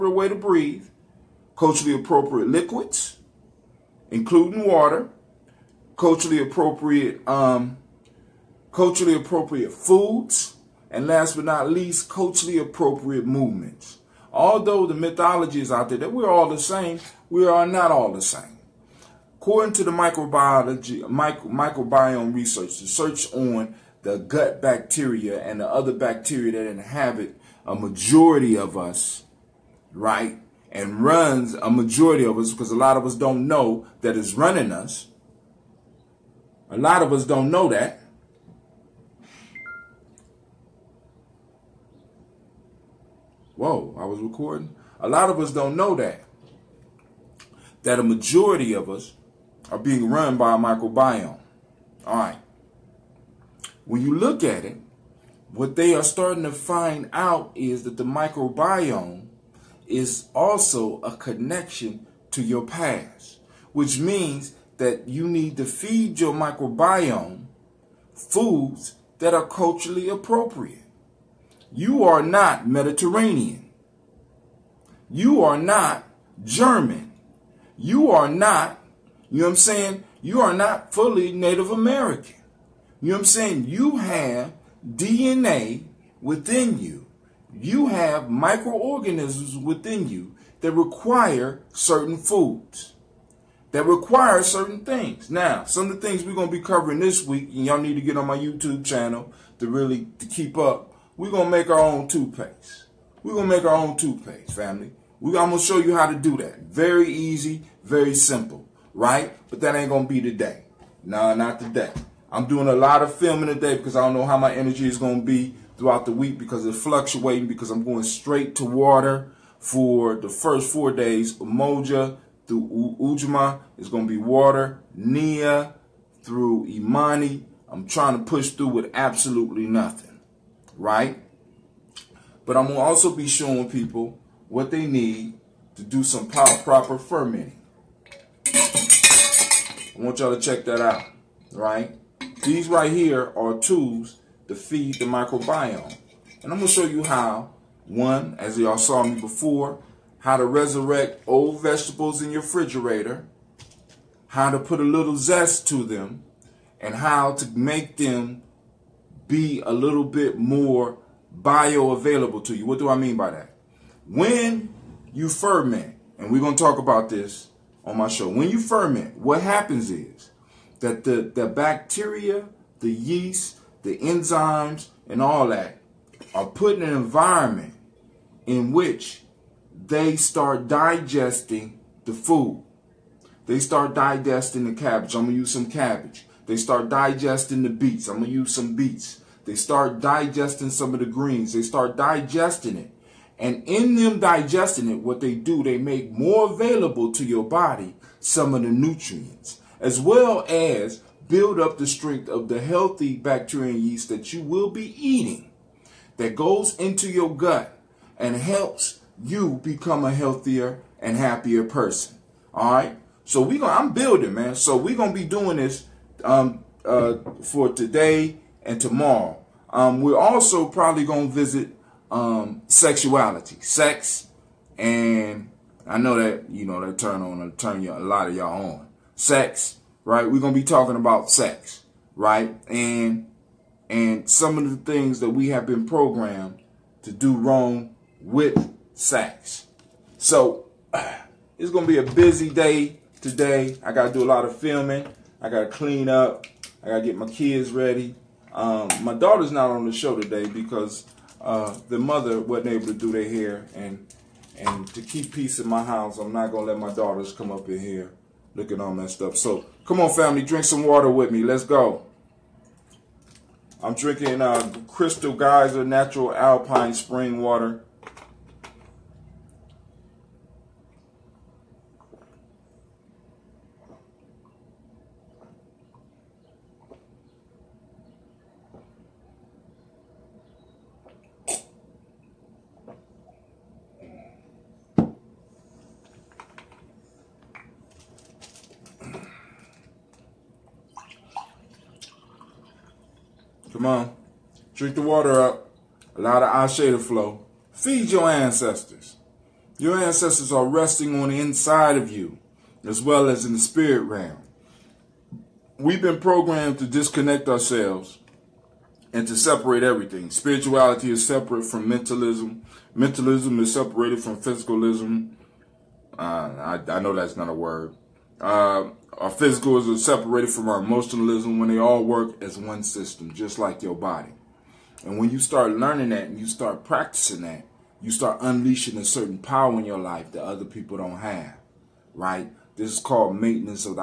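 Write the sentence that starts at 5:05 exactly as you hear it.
We've been programmed to disconnect ourselves and to separate everything.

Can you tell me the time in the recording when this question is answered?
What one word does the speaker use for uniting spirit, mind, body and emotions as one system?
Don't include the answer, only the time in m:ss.
5:33.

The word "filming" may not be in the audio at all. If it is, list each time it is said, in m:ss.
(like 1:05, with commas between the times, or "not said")
1:53, 4:04.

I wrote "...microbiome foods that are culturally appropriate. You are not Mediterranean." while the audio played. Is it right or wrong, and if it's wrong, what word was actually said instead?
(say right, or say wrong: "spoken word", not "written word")
right.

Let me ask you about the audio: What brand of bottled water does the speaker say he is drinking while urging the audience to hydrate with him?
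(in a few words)
Crystal Geyser.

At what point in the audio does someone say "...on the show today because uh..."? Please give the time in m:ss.
4:09.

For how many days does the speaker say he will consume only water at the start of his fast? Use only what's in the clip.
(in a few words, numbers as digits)
4.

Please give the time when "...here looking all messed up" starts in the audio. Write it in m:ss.
4:17.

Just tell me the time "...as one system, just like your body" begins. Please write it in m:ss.
5:22.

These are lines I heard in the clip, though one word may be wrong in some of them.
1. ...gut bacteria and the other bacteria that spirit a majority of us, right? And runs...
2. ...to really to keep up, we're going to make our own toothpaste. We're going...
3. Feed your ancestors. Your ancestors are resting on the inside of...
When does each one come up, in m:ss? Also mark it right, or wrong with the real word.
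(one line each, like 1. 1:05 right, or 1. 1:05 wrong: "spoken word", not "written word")
1. 0:24 wrong: "inhabit", not "spirit"
2. 1:39 right
3. 4:57 right.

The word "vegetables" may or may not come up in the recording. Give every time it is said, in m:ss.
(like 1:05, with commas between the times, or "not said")
2:31.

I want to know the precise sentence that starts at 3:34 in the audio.
So we are gonna be doing this um, uh, for today and tomorrow.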